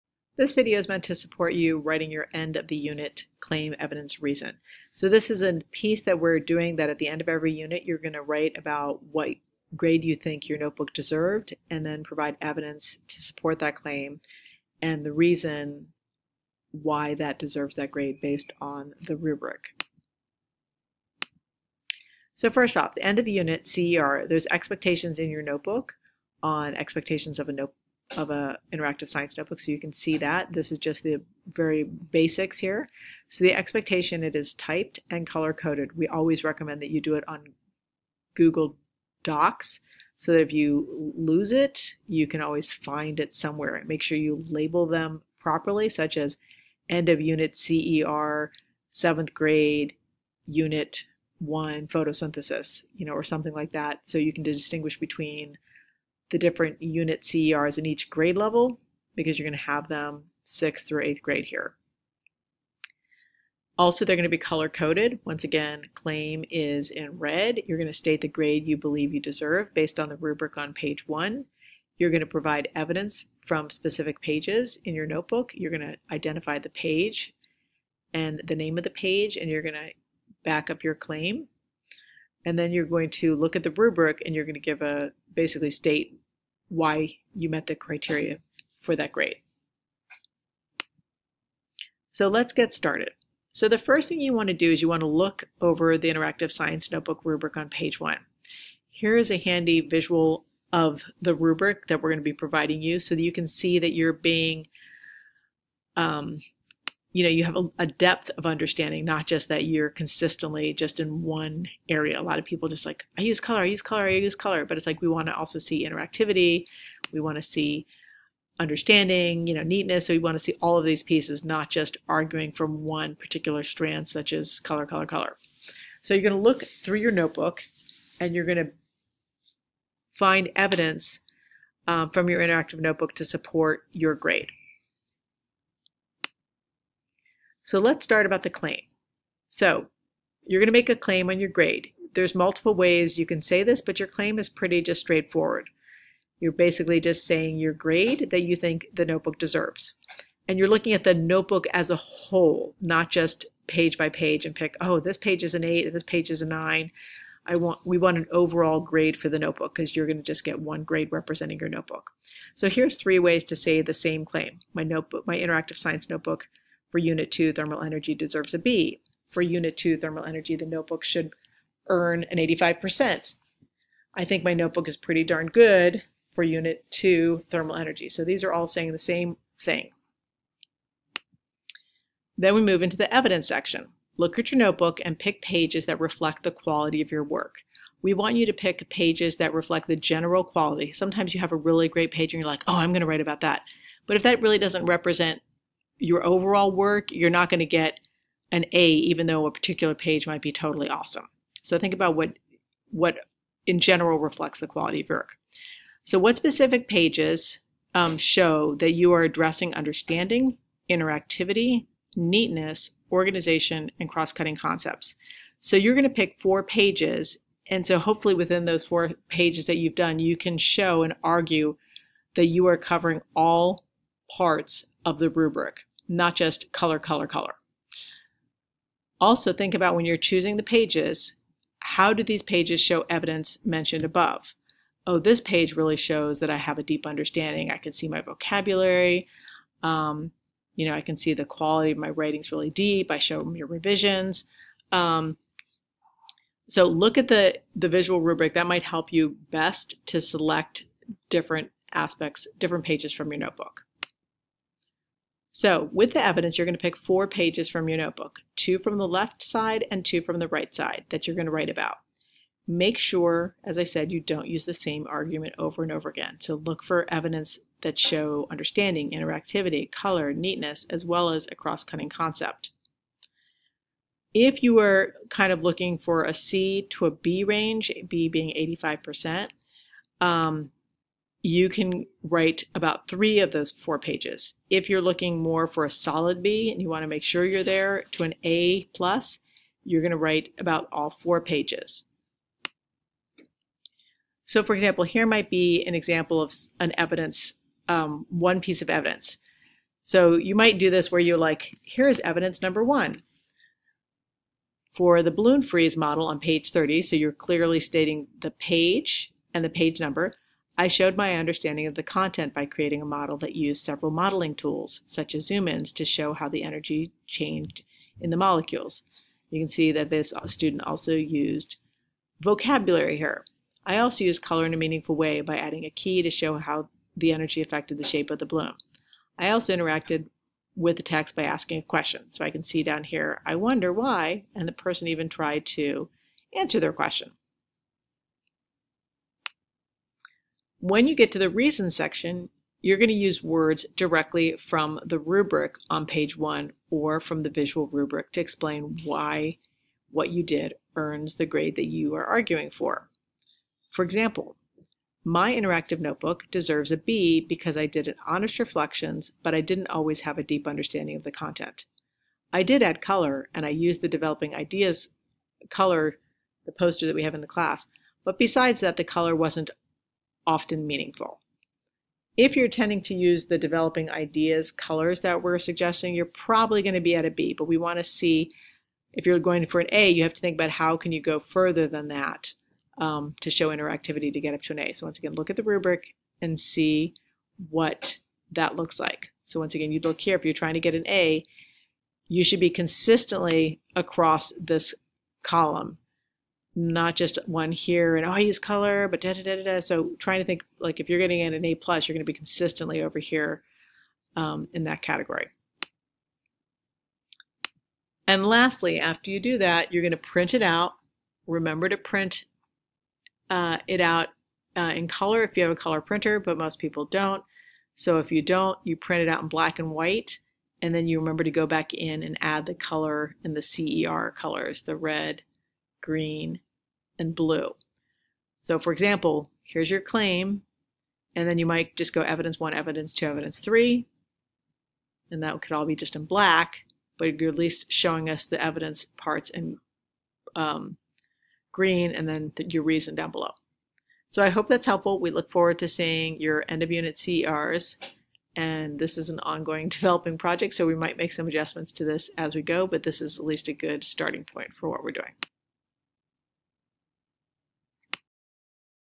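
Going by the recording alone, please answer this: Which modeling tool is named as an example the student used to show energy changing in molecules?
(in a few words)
Zoom-ins.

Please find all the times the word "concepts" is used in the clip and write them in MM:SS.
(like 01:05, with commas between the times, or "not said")
03:34, 04:32.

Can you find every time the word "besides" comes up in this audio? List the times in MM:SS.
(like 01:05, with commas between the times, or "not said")
06:08.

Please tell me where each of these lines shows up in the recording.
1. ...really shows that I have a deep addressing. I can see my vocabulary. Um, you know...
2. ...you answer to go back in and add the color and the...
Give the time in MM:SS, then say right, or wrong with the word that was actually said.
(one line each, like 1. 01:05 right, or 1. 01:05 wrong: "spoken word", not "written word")
1. 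03:55 wrong: "understanding", not "addressing"
2. 07:01 wrong: "remember", not "answer".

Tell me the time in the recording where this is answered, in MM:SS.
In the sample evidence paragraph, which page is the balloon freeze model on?
05:06.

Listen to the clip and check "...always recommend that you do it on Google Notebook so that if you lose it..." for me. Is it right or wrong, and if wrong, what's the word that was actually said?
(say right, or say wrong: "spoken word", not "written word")
wrong: "Docs", not "Notebook".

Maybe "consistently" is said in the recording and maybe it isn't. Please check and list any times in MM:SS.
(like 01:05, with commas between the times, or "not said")
01:49, 06:32, 06:42.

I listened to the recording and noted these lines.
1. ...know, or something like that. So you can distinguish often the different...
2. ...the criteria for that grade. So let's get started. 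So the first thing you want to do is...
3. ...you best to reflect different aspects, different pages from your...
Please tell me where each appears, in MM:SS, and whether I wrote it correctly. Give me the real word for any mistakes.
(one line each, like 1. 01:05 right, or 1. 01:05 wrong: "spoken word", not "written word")
1. 00:53 wrong: "between", not "often"
2. 01:27 right
3. 04:09 wrong: "select", not "reflect".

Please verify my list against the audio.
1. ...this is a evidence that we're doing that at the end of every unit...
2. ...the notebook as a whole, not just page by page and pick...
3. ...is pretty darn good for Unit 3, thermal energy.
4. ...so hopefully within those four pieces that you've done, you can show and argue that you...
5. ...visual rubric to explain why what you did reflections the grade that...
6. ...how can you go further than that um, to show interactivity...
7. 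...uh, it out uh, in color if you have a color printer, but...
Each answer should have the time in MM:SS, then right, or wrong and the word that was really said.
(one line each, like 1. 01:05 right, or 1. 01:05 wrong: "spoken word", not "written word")
1. 00:05 wrong: "piece", not "evidence"
2. 02:31 right
3. 02:54 wrong: "2", not "3"
4. 03:37 wrong: "pages", not "pieces"
5. 05:47 wrong: "earns", not "reflections"
6. 06:20 right
7. 06:53 right.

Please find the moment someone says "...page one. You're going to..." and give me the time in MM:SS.
01:10.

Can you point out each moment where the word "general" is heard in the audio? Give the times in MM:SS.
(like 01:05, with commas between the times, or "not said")
03:09, 03:23.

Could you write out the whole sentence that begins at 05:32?
So I can see down here, I wonder why, and the person even tried to answer their question.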